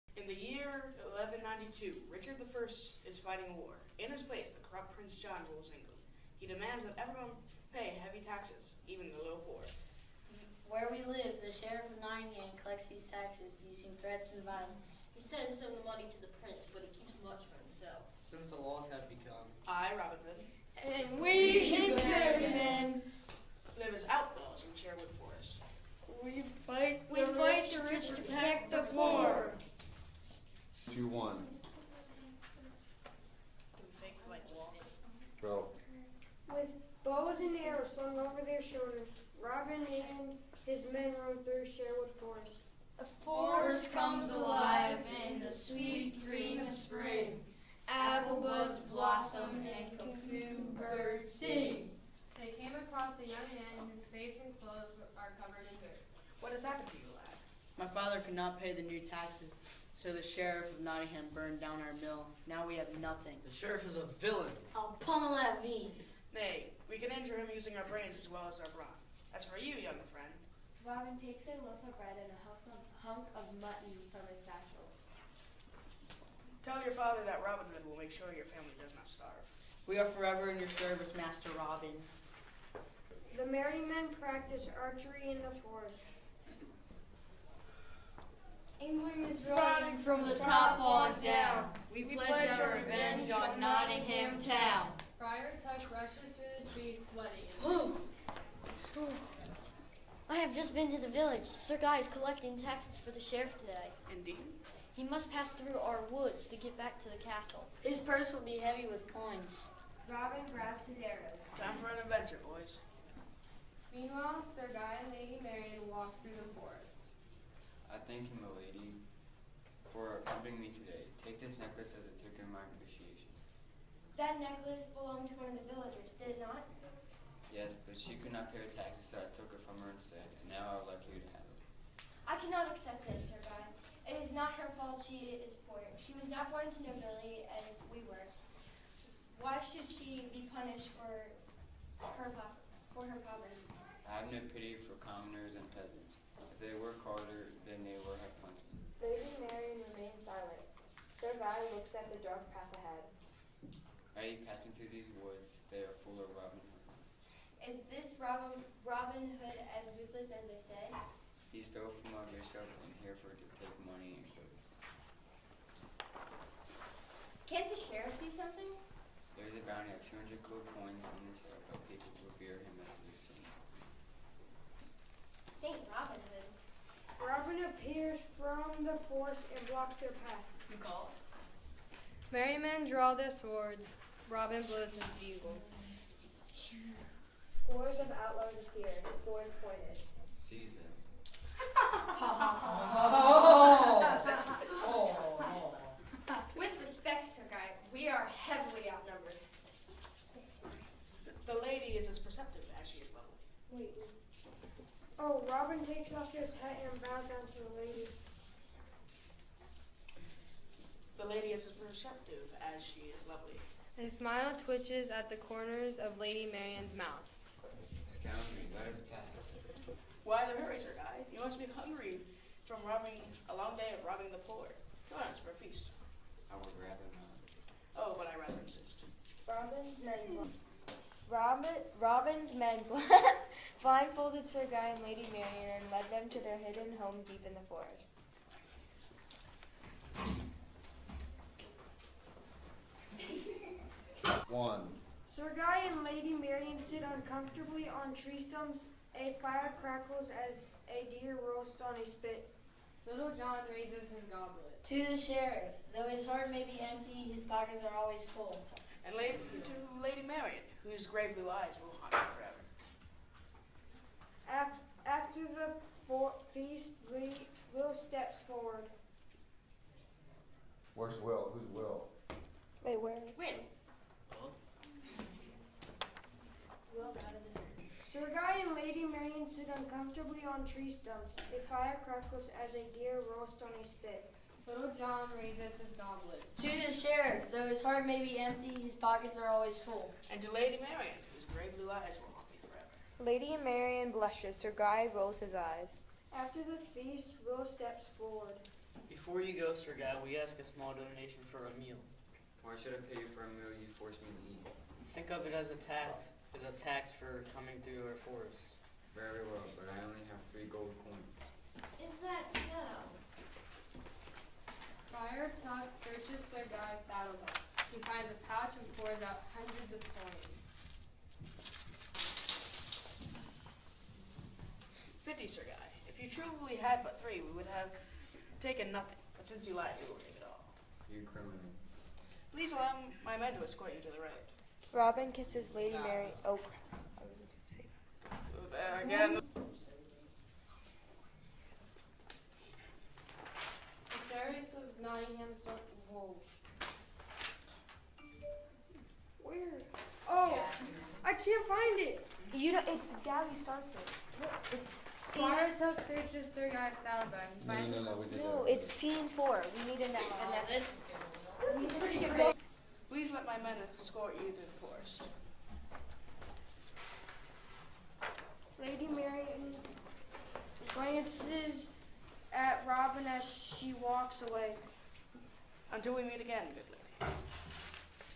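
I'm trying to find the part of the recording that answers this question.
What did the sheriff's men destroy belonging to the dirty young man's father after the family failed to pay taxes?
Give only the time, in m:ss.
1:01.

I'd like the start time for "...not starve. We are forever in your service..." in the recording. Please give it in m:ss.
1:18.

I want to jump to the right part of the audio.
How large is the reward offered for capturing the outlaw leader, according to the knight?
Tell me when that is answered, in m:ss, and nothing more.
2:50.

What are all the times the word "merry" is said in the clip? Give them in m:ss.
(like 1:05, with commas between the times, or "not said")
1:23, 3:02.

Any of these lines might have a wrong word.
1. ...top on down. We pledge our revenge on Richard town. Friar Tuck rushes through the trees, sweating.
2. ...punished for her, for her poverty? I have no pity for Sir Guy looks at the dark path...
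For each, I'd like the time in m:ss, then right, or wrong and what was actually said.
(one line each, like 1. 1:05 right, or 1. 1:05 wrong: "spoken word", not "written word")
1. 1:30 wrong: "Nottingham", not "Richard"
2. 2:20 right.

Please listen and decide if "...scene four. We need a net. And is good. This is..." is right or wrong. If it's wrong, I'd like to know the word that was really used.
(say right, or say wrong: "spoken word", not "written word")
right.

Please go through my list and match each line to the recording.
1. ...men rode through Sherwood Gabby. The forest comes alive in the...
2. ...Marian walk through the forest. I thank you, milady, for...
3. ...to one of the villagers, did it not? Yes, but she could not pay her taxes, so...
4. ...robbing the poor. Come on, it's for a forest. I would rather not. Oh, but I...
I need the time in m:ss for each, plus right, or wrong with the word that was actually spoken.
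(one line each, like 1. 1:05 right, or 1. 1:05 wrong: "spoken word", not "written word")
1. 0:40 wrong: "Forest", not "Gabby"
2. 1:55 right
3. 2:05 right
4. 3:44 wrong: "feast", not "forest".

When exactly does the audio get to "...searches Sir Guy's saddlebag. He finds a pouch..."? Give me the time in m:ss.
5:16.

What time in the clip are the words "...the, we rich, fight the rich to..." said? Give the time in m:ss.
0:27.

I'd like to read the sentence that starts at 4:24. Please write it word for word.
After, the the feast, Lee, Will steps forward.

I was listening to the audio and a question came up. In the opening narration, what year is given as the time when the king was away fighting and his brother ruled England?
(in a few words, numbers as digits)
1192.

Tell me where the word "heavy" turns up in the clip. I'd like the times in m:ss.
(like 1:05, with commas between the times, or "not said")
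0:07, 1:48.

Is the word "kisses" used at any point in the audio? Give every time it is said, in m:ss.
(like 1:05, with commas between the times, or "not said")
5:35.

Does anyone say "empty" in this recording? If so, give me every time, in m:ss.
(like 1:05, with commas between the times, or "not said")
4:16, 4:48.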